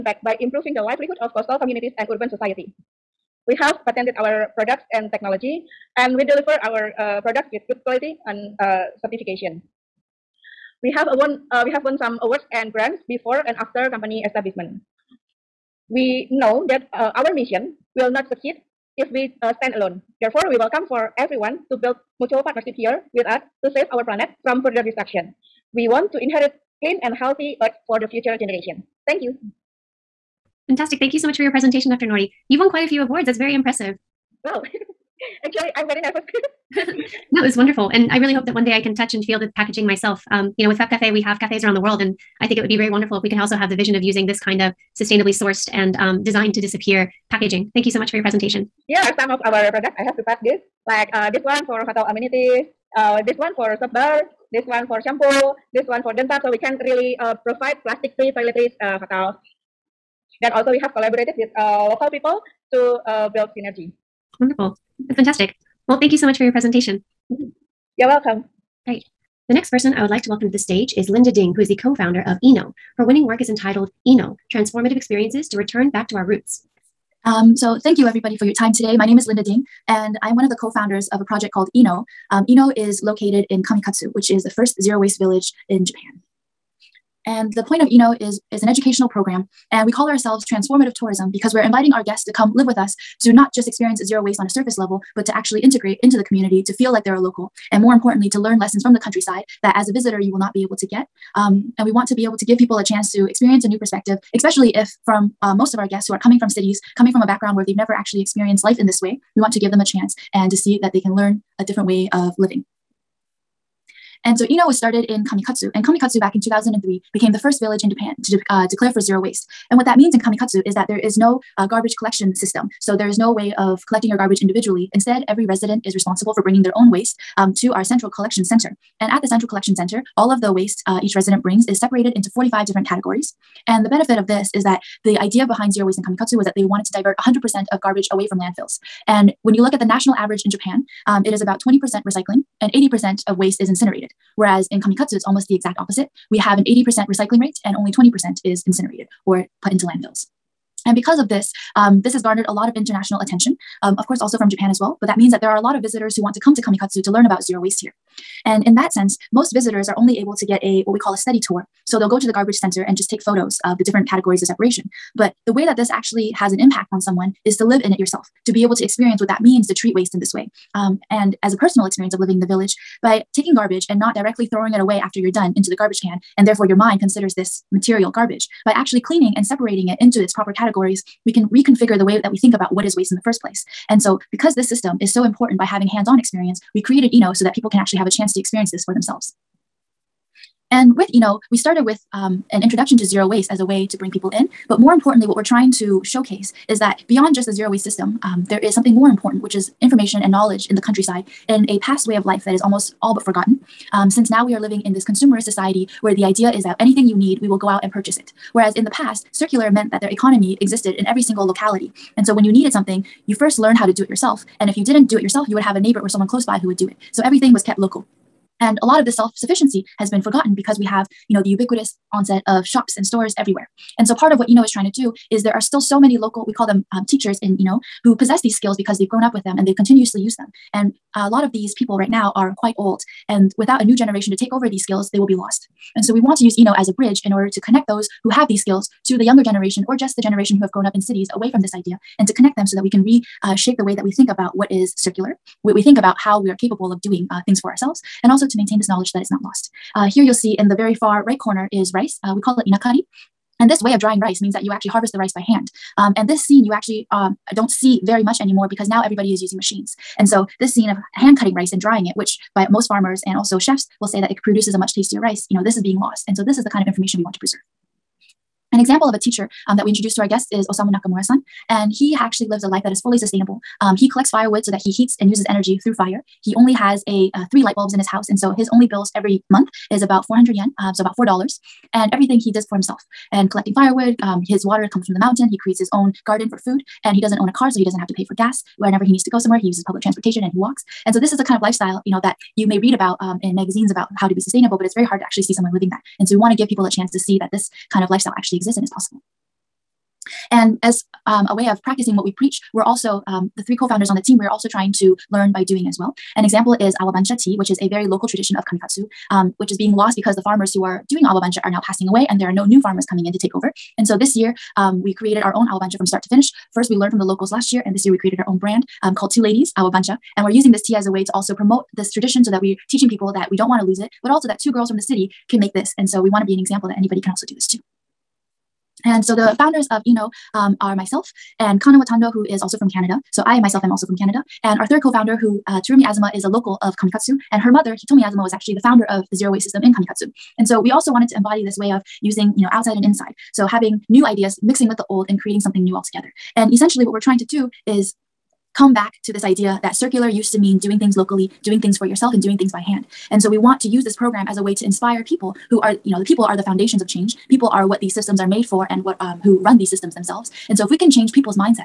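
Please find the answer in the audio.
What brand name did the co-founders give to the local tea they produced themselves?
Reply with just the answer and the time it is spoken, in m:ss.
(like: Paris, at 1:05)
Two Ladies, at 5:19.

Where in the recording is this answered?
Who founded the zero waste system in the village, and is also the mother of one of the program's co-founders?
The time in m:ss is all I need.
5:37.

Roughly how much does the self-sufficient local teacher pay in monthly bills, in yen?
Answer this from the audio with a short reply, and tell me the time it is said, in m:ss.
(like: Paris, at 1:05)
400 yen, at 4:40.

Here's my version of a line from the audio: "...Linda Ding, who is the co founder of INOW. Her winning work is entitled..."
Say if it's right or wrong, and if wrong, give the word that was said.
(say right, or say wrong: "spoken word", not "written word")
right.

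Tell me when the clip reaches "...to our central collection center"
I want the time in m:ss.
2:07.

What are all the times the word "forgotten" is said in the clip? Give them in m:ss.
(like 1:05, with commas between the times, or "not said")
3:23, 3:40.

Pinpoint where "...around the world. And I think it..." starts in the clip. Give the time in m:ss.
0:41.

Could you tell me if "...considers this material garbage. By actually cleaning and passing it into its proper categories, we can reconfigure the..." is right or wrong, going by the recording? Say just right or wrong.
wrong.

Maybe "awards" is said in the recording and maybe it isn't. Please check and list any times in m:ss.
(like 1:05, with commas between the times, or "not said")
0:12, 0:33.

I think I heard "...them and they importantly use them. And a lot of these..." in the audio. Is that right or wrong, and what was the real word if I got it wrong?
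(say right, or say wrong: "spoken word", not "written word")
wrong: "continuously", not "importantly".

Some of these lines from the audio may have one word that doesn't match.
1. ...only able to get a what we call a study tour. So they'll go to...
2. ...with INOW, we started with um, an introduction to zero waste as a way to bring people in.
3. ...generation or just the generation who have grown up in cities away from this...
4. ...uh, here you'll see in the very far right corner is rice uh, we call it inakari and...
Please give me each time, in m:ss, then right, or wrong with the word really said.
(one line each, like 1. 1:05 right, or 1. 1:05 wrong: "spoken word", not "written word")
1. 2:39 right
2. 3:10 right
3. 3:59 right
4. 4:09 right.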